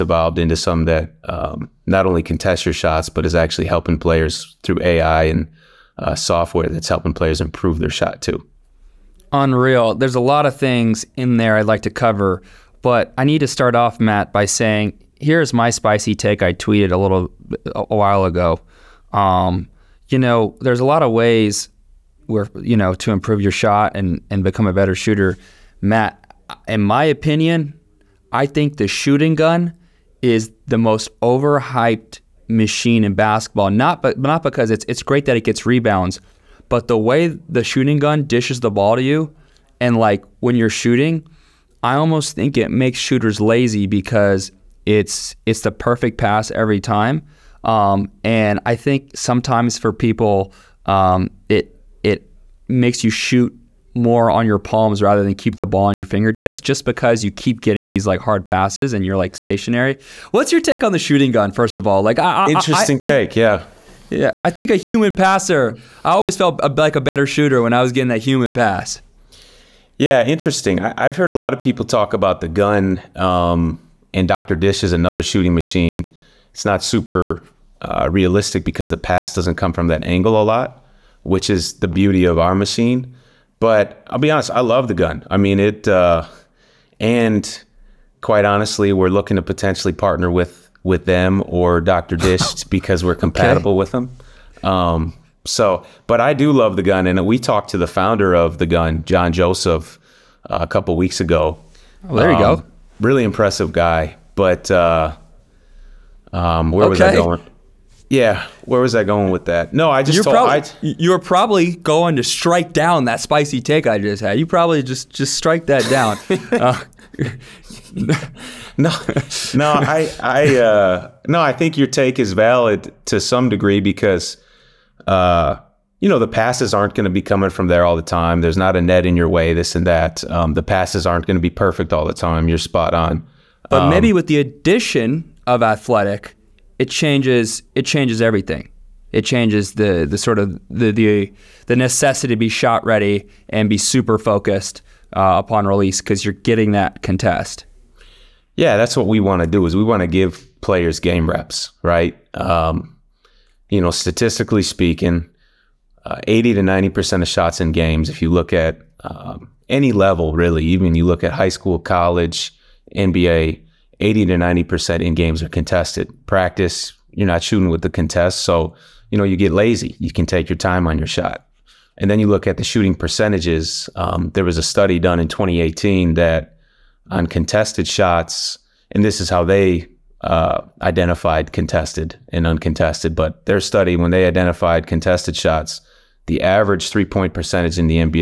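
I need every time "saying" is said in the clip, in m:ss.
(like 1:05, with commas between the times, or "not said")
0:14.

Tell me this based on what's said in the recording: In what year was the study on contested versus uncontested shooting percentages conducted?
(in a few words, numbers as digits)
2018.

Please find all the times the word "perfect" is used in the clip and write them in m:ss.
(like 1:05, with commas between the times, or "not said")
0:45, 2:11.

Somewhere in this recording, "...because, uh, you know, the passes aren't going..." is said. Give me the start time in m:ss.
2:03.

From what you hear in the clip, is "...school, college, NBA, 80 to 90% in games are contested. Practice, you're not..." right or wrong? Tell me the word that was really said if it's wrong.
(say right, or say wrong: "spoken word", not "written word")
right.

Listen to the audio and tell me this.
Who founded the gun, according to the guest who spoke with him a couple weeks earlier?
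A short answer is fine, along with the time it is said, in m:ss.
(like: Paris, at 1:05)
John Joseph, at 1:39.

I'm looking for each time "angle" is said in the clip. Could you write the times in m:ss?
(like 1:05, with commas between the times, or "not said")
1:20.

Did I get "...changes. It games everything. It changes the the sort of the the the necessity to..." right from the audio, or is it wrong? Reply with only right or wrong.
wrong.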